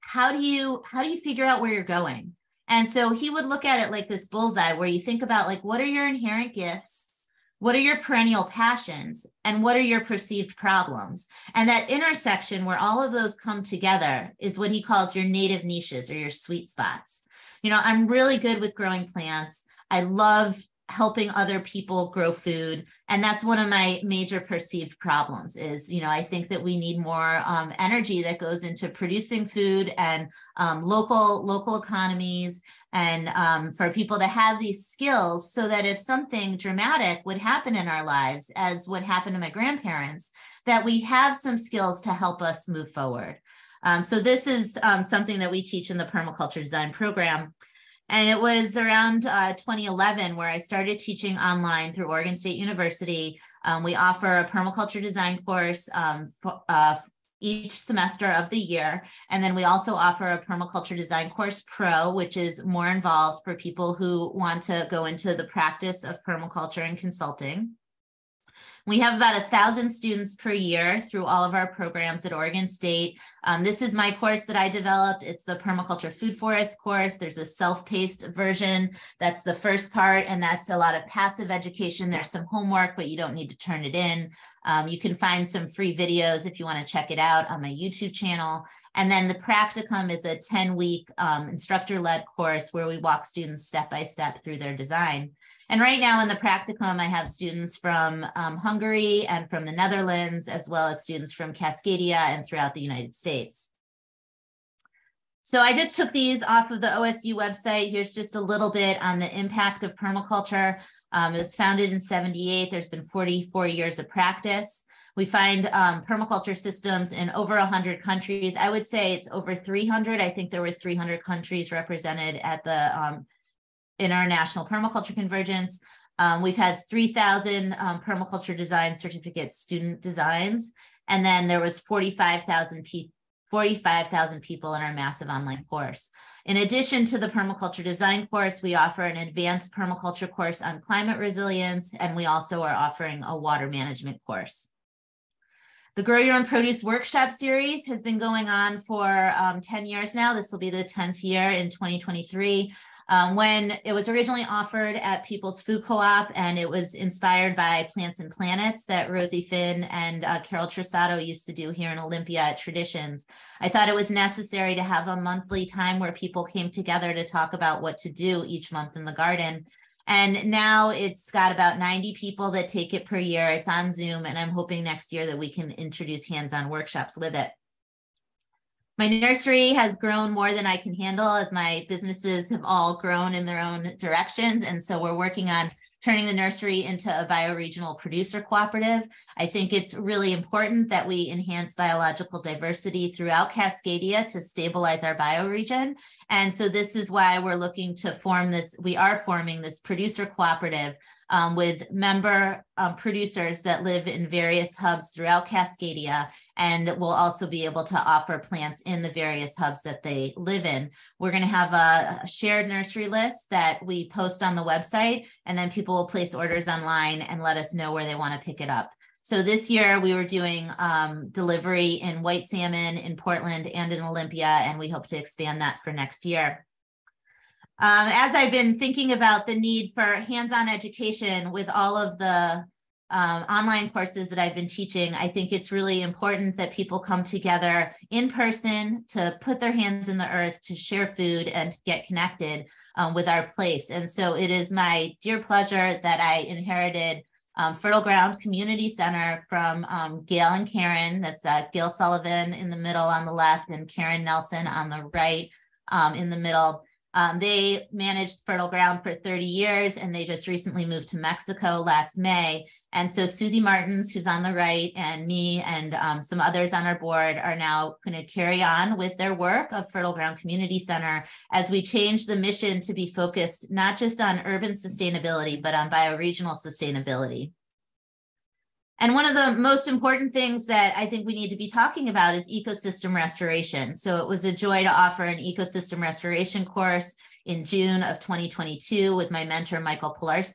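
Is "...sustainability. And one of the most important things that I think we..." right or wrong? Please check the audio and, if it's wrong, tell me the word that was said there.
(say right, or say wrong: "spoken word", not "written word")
right.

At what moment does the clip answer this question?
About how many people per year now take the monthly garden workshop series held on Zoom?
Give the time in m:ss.
2:51.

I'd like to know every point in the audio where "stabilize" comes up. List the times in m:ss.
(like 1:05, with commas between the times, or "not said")
3:14.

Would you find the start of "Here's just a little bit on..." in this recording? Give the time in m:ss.
1:47.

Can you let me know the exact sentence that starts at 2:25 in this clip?
The Grow Your Own Produce Workshop Series has been going on for um, 10 years now.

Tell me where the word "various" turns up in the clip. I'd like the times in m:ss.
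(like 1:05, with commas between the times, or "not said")
3:24, 3:29.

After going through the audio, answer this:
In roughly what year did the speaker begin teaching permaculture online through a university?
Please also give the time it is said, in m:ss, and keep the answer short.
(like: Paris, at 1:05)
2011, at 0:49.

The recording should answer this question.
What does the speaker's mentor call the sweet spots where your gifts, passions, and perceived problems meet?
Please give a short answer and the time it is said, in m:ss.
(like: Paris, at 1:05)
native niches, at 0:15.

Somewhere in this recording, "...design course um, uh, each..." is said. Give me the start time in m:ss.
0:55.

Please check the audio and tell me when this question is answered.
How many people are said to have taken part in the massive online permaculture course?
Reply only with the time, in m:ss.
2:11.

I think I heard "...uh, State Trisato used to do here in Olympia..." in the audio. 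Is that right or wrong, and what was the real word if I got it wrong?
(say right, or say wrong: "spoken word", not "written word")
wrong: "Carol", not "State".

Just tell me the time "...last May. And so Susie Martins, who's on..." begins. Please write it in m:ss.
4:21.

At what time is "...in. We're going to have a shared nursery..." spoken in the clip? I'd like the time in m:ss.
3:30.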